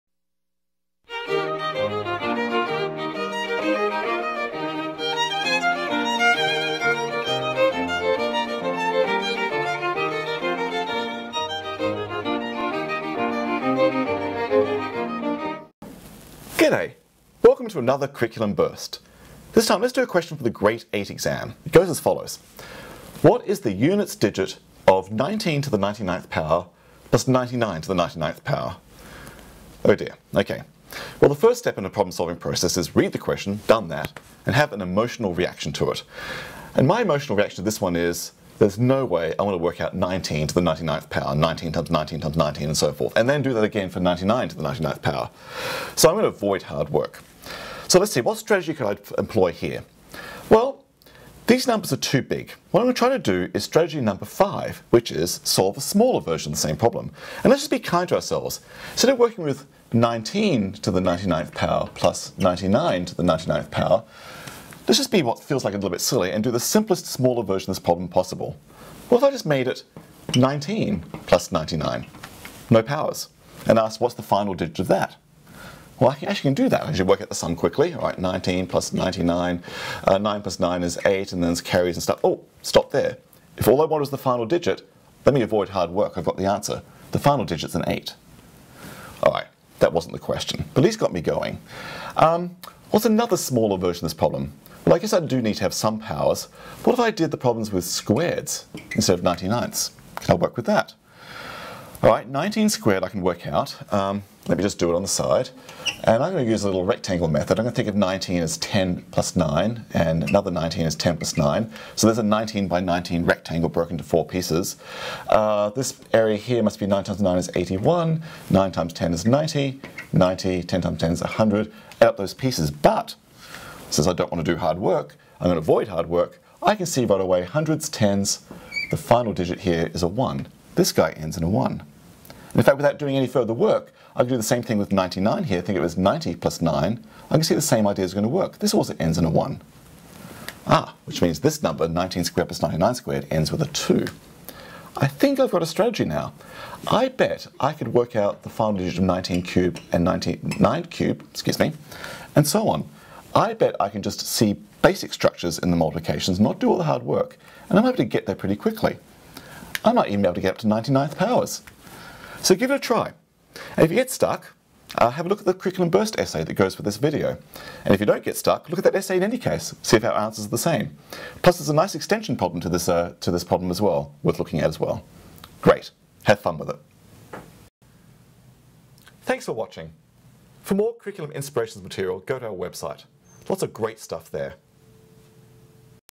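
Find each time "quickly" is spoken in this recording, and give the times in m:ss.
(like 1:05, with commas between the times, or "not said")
1:17, 2:38.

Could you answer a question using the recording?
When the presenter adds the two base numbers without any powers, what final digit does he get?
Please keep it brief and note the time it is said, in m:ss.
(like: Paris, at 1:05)
8, at 1:27.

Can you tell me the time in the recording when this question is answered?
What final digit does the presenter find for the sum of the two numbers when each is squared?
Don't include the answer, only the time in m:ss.
2:23.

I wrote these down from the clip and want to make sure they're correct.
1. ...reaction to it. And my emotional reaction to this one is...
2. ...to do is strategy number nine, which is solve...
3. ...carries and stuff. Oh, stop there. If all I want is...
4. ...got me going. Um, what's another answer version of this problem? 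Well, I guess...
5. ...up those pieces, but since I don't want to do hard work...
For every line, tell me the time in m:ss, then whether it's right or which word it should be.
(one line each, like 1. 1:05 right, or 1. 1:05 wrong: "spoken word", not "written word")
1. 0:35 right
2. 0:53 wrong: "five", not "nine"
3. 1:21 right
4. 1:30 wrong: "smaller", not "answer"
5. 2:02 right.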